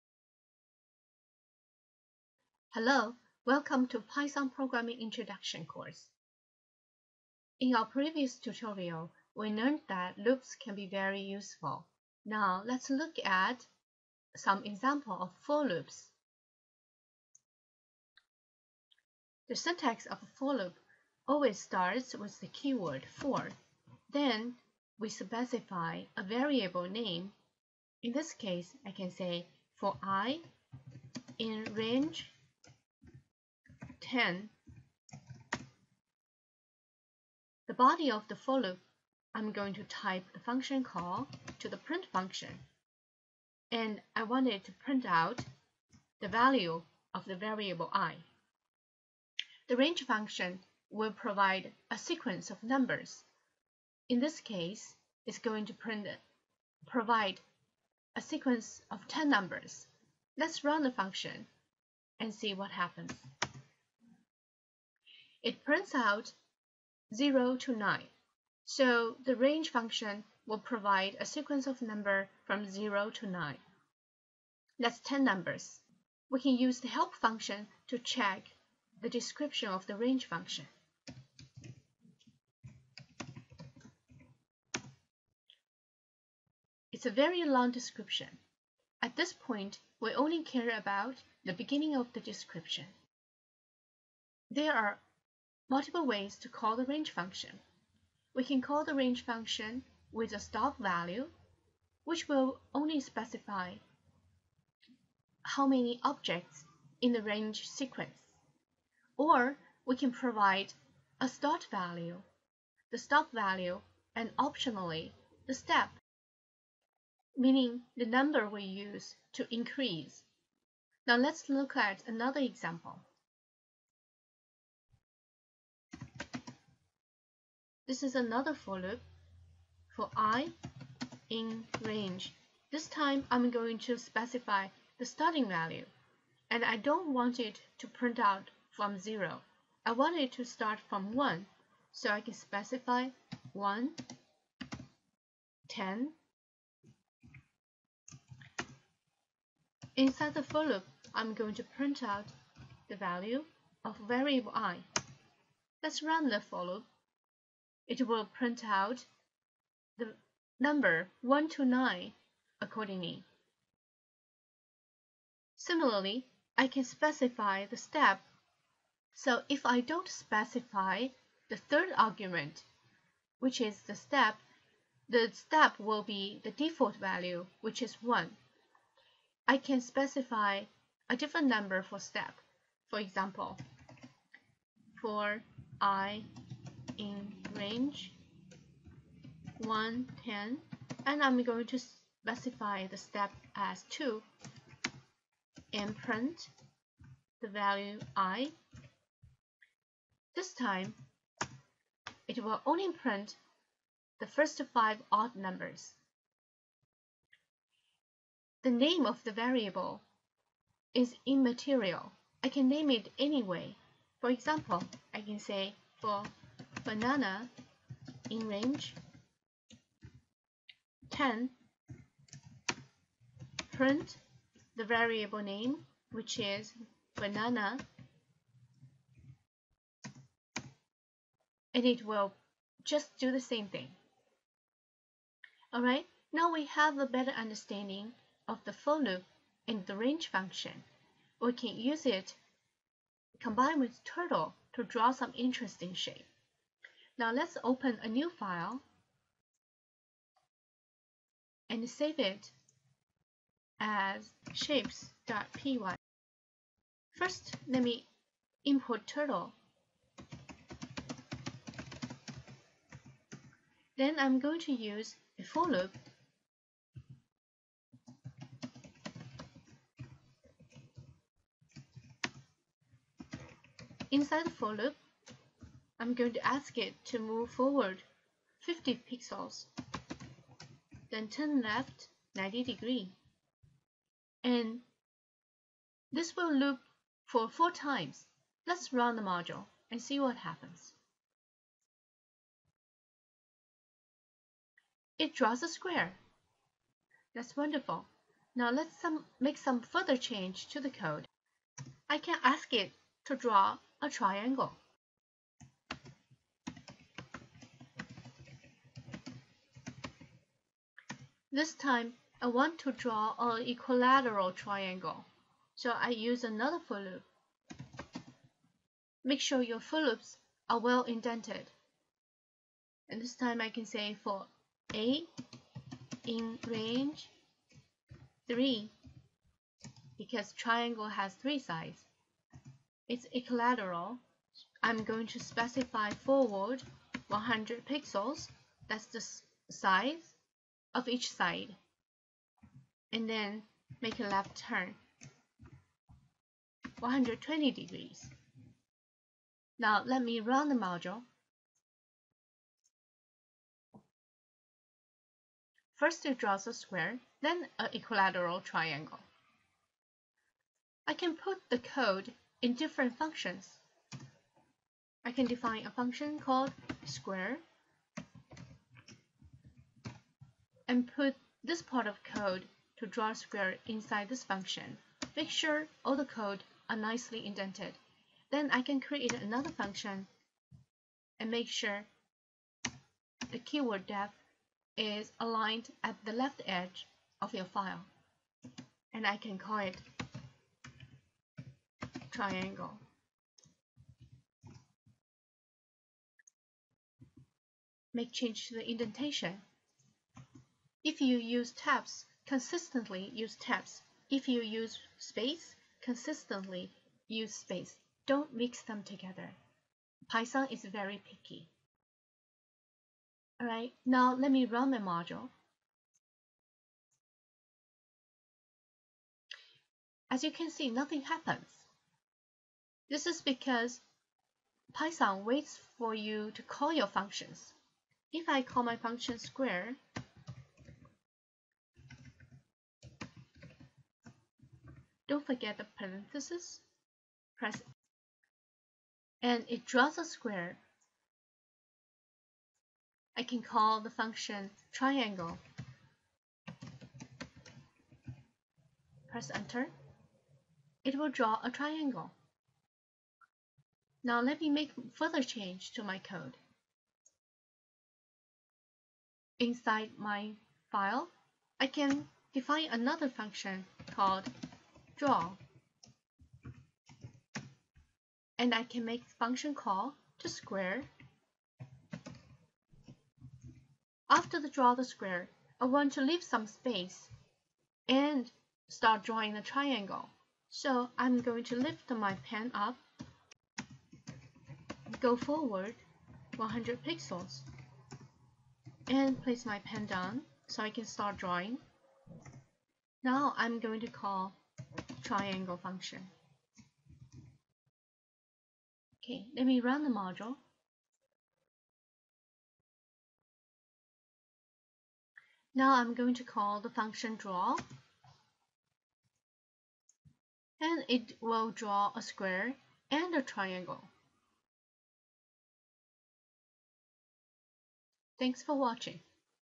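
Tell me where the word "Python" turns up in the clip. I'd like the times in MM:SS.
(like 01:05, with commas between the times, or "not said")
00:03, 06:50, 07:04.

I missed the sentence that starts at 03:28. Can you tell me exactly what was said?
The name of the variable is immaterial.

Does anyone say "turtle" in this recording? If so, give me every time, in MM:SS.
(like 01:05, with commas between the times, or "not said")
04:04, 04:19.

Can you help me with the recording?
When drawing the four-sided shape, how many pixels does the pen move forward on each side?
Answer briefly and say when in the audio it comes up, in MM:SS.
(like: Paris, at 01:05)
50, at 04:38.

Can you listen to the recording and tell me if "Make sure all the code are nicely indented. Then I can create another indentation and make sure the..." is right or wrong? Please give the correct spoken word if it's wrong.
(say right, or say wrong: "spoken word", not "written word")
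wrong: "function", not "indentation".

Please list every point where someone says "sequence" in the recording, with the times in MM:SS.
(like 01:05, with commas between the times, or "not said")
00:51, 00:58, 01:11, 01:47.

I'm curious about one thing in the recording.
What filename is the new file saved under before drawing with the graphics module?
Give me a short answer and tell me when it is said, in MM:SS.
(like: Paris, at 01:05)
shapes.py, at 04:14.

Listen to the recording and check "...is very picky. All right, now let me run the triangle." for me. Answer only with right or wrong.
wrong.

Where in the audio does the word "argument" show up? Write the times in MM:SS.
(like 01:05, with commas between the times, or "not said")
02:51.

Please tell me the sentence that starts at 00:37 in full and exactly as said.
The body of the for loop, I'm going to type the function call to the print function.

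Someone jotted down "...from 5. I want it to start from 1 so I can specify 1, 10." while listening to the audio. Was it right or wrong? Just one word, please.
wrong.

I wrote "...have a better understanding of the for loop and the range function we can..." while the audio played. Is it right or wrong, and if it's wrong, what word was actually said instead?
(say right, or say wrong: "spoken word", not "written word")
right.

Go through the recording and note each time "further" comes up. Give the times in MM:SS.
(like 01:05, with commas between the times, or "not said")
04:59, 07:35.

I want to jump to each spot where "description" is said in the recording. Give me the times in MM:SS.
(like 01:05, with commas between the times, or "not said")
01:19, 01:27, 01:32.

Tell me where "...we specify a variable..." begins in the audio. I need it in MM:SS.
00:24.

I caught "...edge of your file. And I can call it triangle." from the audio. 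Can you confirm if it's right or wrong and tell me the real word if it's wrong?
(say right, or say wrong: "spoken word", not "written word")
right.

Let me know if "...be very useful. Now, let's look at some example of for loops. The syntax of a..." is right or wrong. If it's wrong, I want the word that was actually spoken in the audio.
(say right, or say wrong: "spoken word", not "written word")
right.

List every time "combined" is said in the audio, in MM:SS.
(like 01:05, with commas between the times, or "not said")
04:03.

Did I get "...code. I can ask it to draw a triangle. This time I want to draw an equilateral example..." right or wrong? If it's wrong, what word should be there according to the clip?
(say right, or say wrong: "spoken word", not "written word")
wrong: "triangle", not "example".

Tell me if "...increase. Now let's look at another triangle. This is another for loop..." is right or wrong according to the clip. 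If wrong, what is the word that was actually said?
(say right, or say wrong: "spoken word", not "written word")
wrong: "example", not "triangle".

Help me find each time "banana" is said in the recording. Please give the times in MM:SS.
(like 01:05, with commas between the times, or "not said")
03:36, 03:47.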